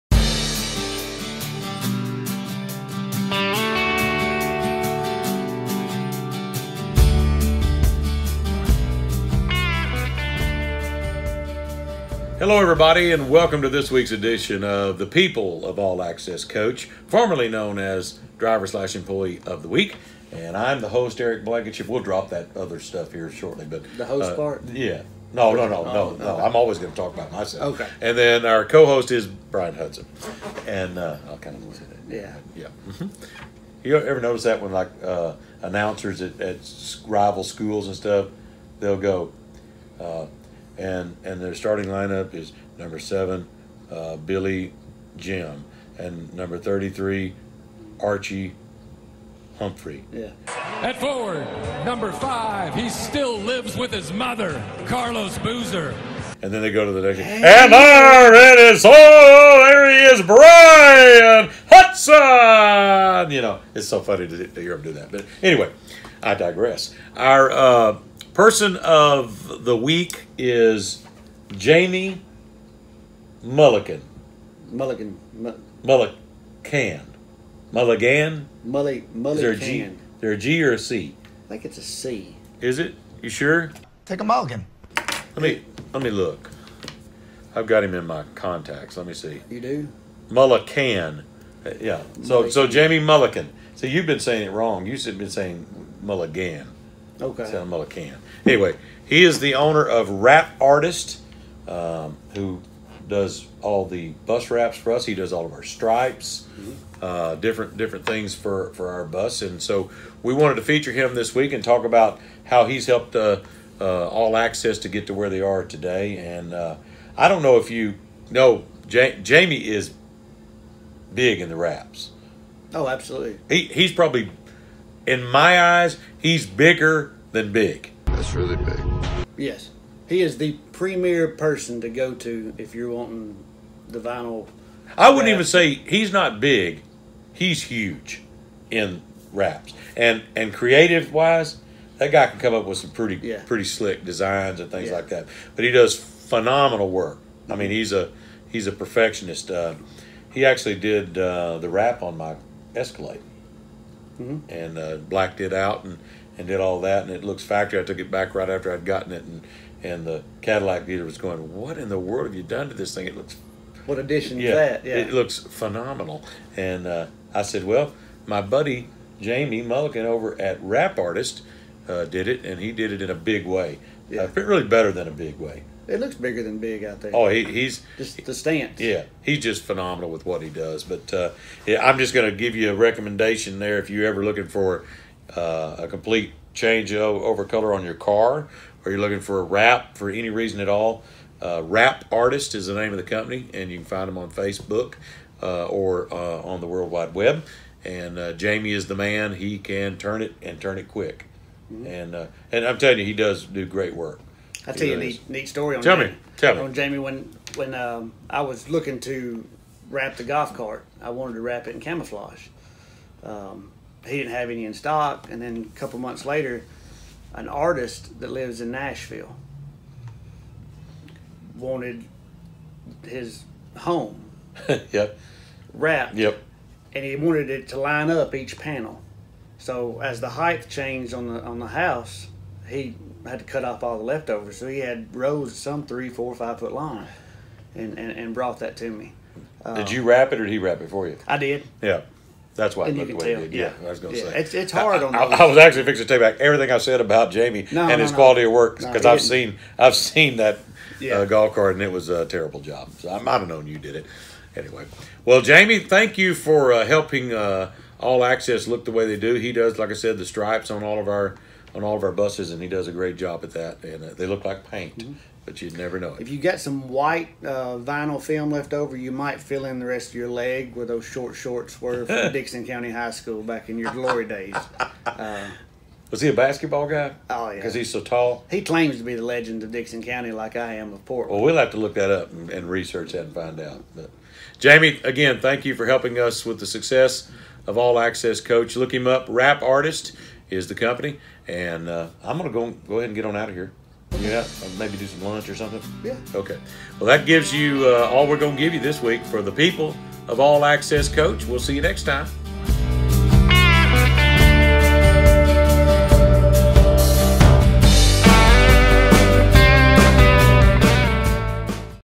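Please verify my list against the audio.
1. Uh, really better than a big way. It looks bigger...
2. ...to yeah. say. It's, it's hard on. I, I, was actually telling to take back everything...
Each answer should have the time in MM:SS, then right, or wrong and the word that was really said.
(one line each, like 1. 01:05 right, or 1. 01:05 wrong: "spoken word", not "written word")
1. 02:54 right
2. 04:04 wrong: "fixing", not "telling".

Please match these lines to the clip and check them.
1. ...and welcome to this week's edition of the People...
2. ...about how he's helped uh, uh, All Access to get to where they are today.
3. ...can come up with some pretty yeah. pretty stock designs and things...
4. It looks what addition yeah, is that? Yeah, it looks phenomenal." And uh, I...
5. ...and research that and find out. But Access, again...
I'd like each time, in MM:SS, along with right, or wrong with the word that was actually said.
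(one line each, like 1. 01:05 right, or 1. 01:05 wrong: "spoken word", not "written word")
1. 00:13 right
2. 01:51 right
3. 02:22 wrong: "slick", not "stock"
4. 02:43 right
5. 04:42 wrong: "Jamie", not "Access".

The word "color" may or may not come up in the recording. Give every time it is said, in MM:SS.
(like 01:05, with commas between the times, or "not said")
03:07.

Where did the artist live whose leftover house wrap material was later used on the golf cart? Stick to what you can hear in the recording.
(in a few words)
Nashville.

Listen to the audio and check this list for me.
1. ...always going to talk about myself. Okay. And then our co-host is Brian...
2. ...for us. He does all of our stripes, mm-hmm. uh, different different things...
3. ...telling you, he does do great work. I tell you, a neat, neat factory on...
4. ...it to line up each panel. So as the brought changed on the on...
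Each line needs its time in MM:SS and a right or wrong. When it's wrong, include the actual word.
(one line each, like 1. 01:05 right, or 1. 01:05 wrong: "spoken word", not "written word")
1. 00:26 right
2. 01:44 right
3. 03:22 wrong: "story", not "factory"
4. 03:47 wrong: "height", not "brought".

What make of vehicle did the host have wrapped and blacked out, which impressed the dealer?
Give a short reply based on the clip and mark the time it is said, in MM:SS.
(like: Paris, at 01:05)
Escalade, at 02:32.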